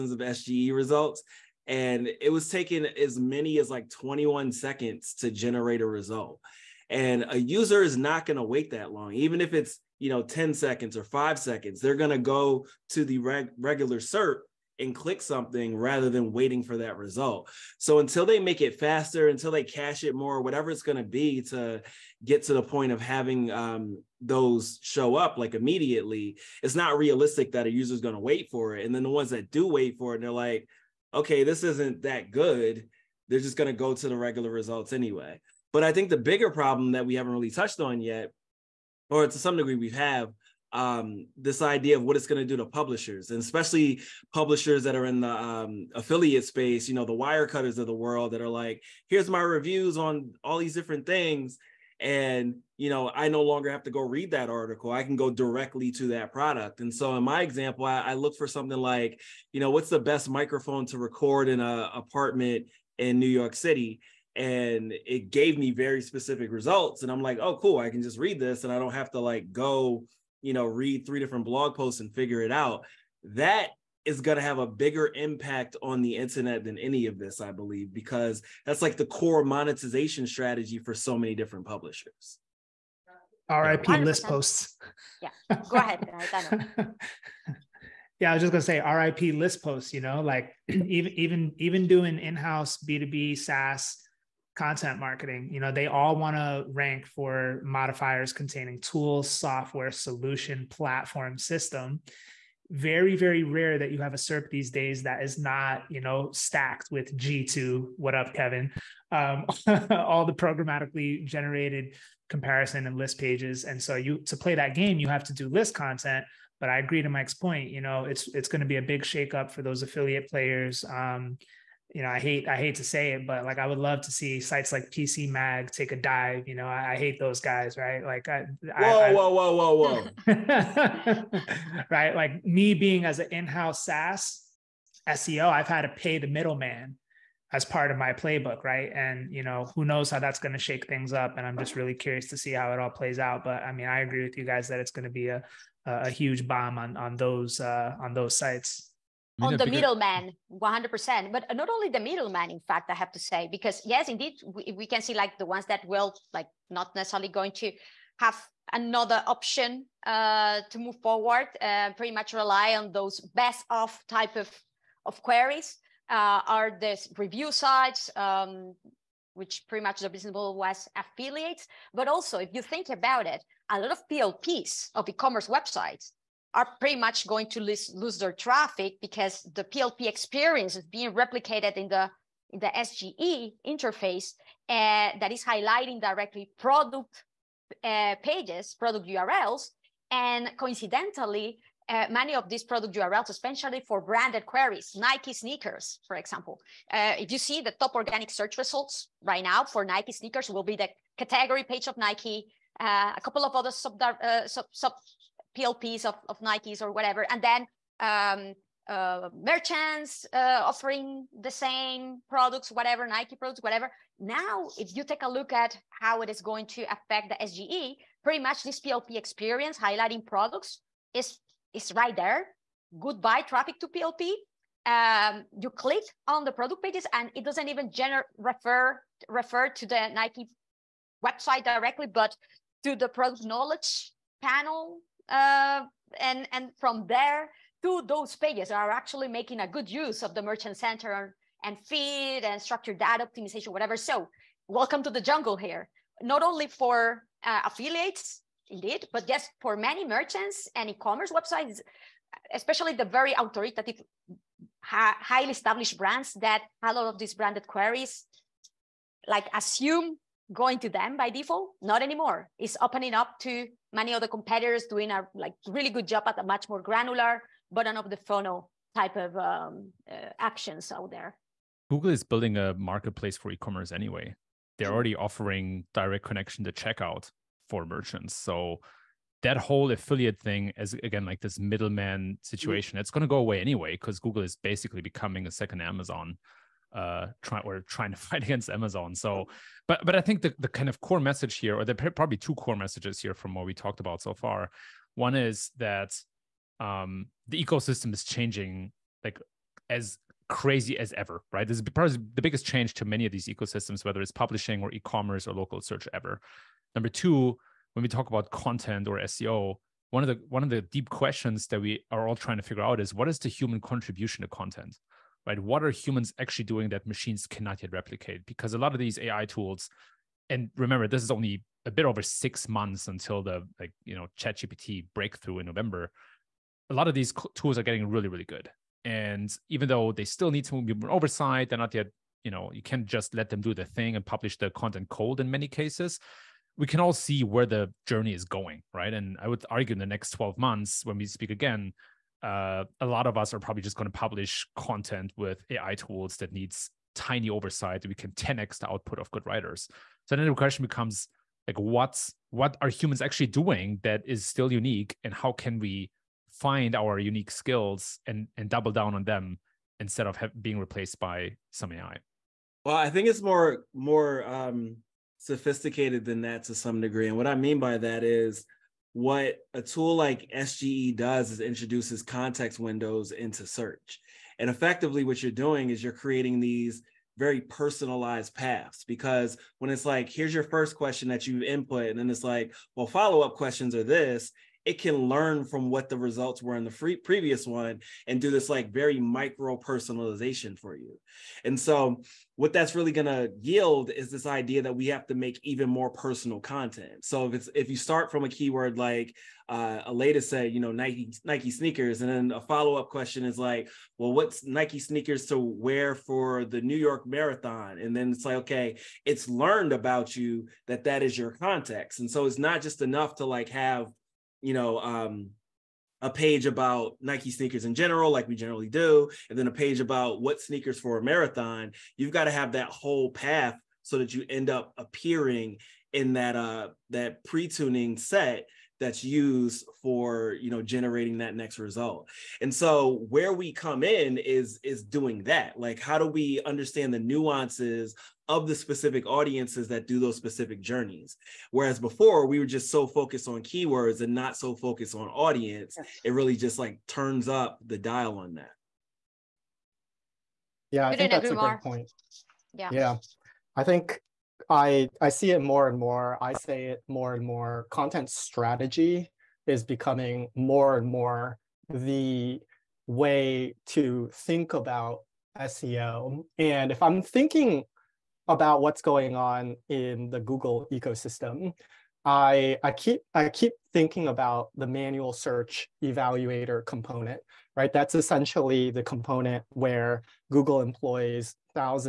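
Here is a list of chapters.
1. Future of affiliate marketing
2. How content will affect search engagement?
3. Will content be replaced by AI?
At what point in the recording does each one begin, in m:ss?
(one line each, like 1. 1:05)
1. 0:34
2. 7:30
3. 4:03.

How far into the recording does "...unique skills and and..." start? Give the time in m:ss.
5:57.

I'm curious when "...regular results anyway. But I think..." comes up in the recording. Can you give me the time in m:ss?
0:34.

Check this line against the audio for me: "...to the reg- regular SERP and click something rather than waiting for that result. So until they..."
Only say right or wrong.
right.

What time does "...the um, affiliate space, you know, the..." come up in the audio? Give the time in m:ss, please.
0:45.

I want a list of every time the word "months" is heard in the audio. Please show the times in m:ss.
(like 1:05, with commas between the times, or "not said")
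5:22, 5:40.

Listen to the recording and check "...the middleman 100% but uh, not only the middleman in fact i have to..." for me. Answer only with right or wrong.
right.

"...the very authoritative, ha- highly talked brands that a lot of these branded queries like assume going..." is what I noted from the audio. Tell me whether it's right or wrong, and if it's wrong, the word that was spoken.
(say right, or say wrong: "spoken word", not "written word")
wrong: "established", not "talked".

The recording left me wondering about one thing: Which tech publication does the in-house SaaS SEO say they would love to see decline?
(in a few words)
PC Mag.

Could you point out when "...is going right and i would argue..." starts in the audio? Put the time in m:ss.
5:38.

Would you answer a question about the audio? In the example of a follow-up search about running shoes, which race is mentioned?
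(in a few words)
New York Marathon.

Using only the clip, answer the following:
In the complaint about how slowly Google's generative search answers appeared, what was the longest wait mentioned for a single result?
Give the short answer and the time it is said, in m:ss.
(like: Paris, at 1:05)
21 seconds, at 0:03.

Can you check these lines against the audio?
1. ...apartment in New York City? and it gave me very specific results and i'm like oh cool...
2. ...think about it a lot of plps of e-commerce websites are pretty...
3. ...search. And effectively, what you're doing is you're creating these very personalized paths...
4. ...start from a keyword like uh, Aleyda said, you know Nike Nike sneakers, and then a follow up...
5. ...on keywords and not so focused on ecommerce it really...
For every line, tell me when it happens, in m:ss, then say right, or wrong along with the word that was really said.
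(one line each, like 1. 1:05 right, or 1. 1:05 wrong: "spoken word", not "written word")
1. 1:01 right
2. 2:52 right
3. 6:13 right
4. 6:37 right
5. 7:23 wrong: "audience", not "ecommerce".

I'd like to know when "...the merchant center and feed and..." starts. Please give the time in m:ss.
4:00.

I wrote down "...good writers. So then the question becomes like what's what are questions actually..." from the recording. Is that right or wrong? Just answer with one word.
wrong.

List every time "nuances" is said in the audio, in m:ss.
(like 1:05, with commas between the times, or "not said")
7:17.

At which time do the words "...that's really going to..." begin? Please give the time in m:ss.
6:32.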